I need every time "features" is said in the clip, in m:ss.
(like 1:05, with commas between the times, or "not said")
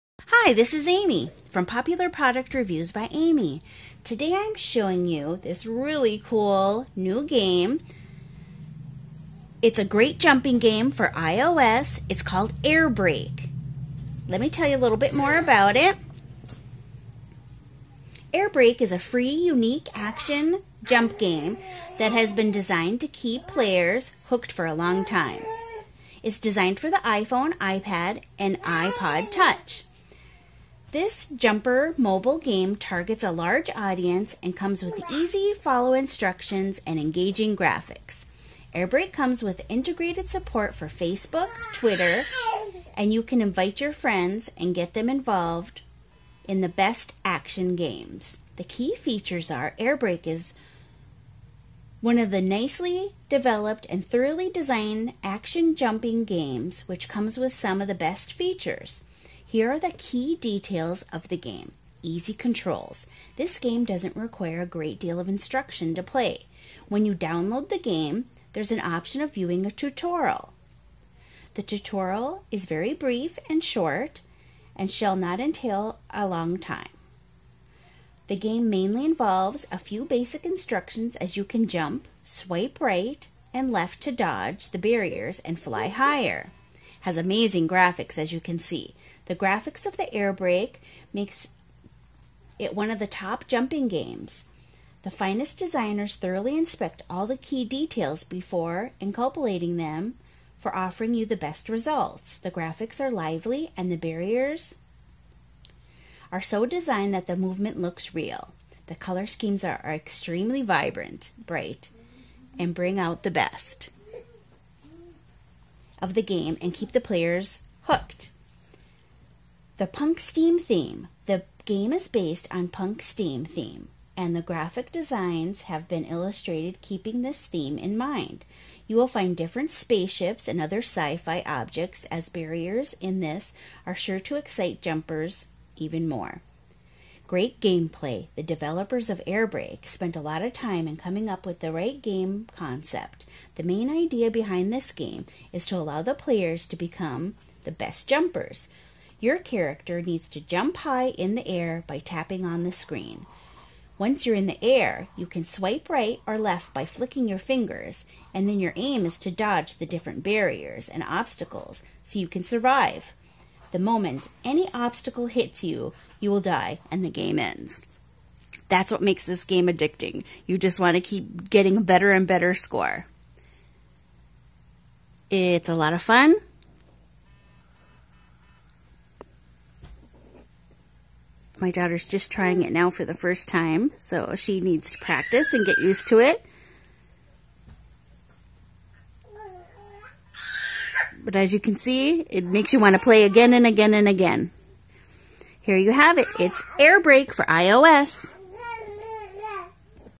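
0:48, 0:58.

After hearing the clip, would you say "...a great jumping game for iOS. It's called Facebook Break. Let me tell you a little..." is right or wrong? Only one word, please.
wrong.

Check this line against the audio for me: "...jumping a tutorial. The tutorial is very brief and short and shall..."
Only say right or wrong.
wrong.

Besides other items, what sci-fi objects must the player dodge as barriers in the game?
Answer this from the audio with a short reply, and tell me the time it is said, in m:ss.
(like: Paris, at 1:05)
Spaceships, at 2:09.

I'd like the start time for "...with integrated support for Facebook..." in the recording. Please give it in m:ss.
0:39.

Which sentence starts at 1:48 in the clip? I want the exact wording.
The color schemes are, are extremely vibrant, bright, and bring out the best of the game and keep the players hooked.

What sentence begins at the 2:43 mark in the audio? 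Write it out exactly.
The moment any obstacle hits you, you will die, and the game ends.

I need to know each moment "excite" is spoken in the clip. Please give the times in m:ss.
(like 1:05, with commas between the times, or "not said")
2:14.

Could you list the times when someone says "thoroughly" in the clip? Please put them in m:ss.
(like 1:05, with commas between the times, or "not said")
0:54, 1:36.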